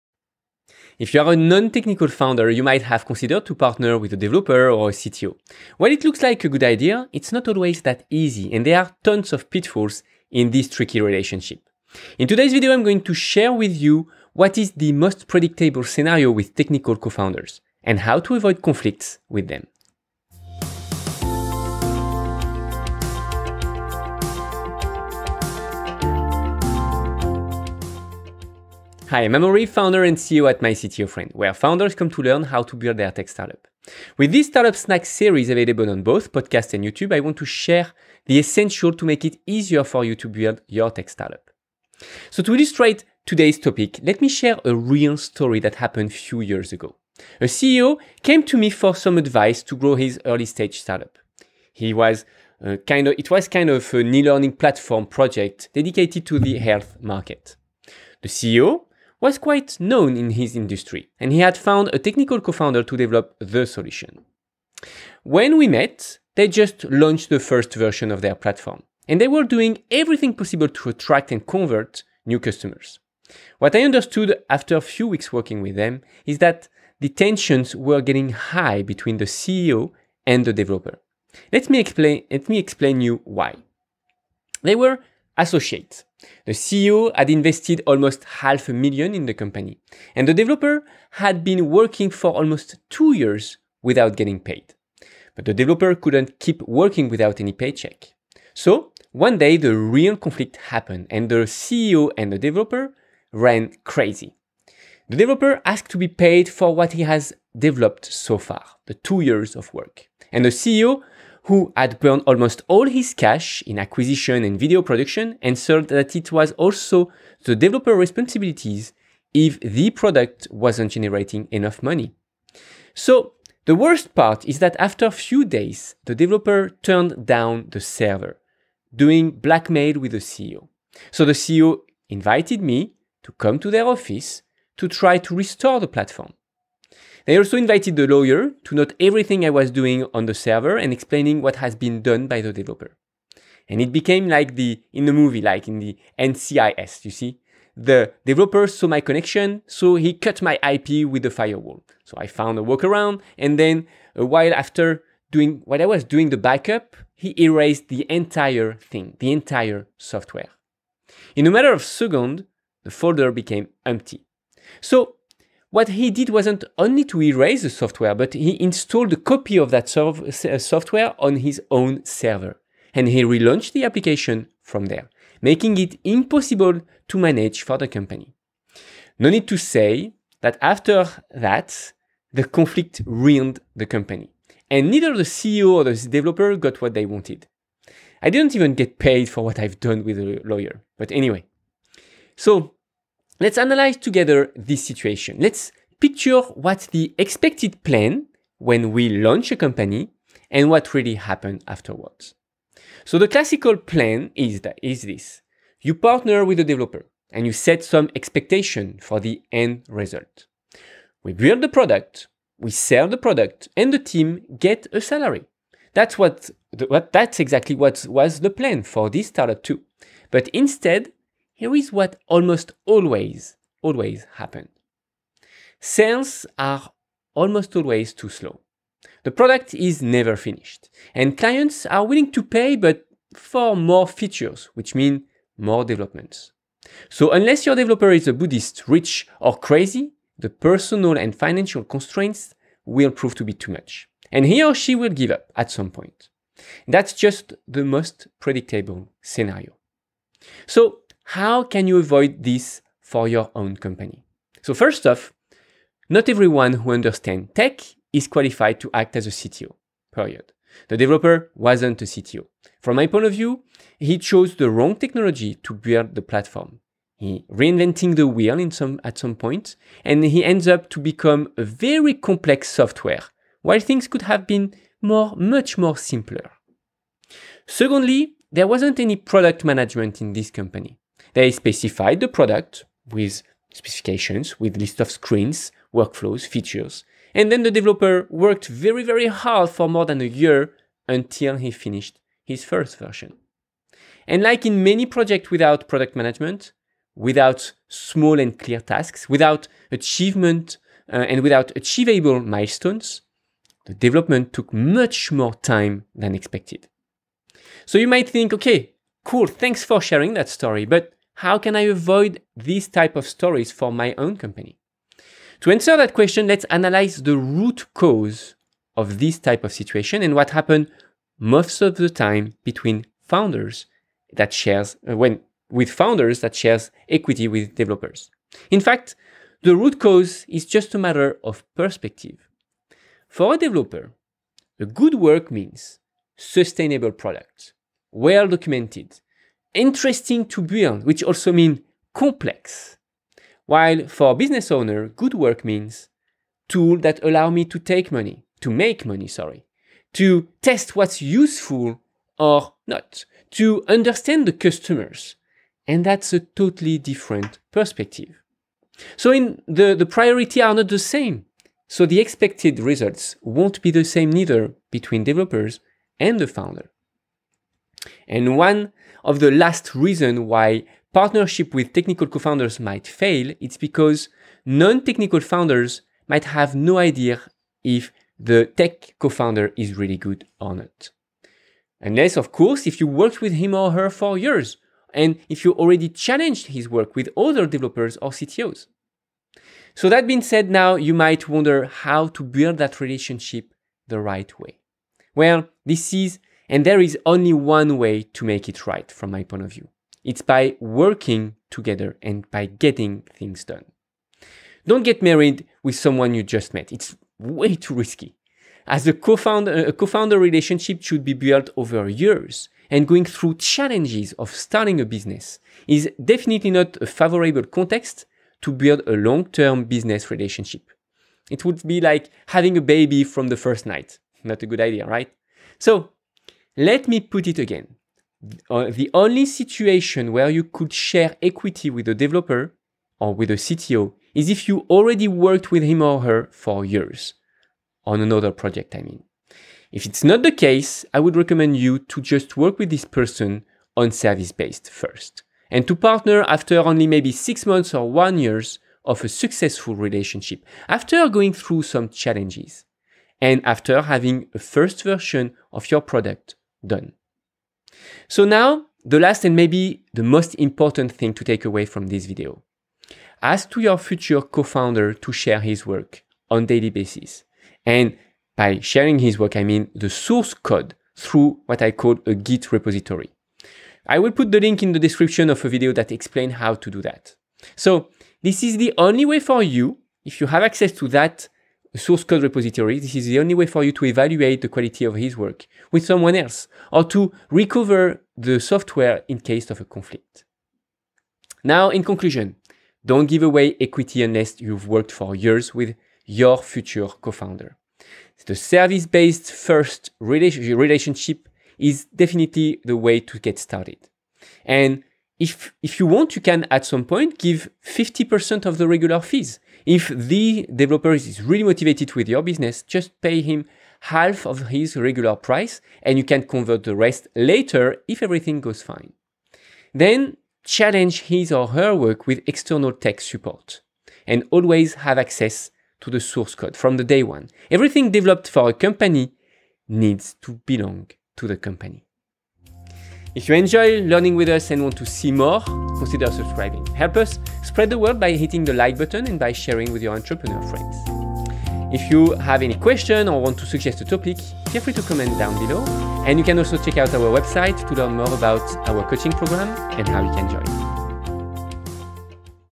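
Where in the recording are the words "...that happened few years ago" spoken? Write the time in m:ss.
0:45.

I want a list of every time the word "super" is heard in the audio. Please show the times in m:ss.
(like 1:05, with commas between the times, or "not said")
not said.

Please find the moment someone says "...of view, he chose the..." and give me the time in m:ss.
4:23.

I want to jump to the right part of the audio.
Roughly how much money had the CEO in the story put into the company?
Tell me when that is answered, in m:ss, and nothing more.
1:28.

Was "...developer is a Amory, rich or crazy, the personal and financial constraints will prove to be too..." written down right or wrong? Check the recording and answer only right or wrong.
wrong.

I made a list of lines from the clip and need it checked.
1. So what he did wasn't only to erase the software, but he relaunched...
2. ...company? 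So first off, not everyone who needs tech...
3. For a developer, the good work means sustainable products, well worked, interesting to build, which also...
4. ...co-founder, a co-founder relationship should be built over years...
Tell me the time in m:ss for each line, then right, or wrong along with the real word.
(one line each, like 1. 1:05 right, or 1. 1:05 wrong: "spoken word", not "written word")
1. 2:44 wrong: "installed", not "relaunched"
2. 4:13 wrong: "understands", not "needs"
3. 5:33 wrong: "documented", not "worked"
4. 6:49 right.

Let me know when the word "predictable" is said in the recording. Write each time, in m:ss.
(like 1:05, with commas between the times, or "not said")
0:15, 4:08.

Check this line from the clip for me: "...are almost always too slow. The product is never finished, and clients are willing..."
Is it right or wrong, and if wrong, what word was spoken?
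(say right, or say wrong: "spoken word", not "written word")
right.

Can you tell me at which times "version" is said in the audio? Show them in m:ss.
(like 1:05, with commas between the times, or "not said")
1:07, 4:52, 7:35.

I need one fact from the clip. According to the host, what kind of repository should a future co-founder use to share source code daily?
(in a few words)
Git repository.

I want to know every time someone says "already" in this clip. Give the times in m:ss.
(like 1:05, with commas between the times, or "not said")
6:25, 7:14.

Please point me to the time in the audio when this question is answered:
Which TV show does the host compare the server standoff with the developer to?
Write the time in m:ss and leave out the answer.
2:26.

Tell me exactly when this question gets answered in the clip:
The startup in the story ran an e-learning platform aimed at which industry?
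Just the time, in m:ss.
0:56.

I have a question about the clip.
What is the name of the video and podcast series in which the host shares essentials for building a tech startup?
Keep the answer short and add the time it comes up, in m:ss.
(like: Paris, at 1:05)
startup snack, at 0:34.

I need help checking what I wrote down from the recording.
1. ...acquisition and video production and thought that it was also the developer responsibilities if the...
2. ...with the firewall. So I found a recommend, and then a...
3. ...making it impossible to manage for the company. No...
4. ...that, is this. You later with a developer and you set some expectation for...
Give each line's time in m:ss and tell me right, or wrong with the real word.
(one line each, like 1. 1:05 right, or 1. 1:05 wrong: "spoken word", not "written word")
1. 1:53 right
2. 2:31 wrong: "workaround", not "recommend"
3. 2:55 right
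4. 3:24 wrong: "partner", not "later".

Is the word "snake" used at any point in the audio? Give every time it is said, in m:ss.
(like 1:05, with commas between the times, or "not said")
not said.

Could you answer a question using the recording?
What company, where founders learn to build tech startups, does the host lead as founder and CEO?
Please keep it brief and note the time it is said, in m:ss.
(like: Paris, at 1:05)
My Friend, at 0:30.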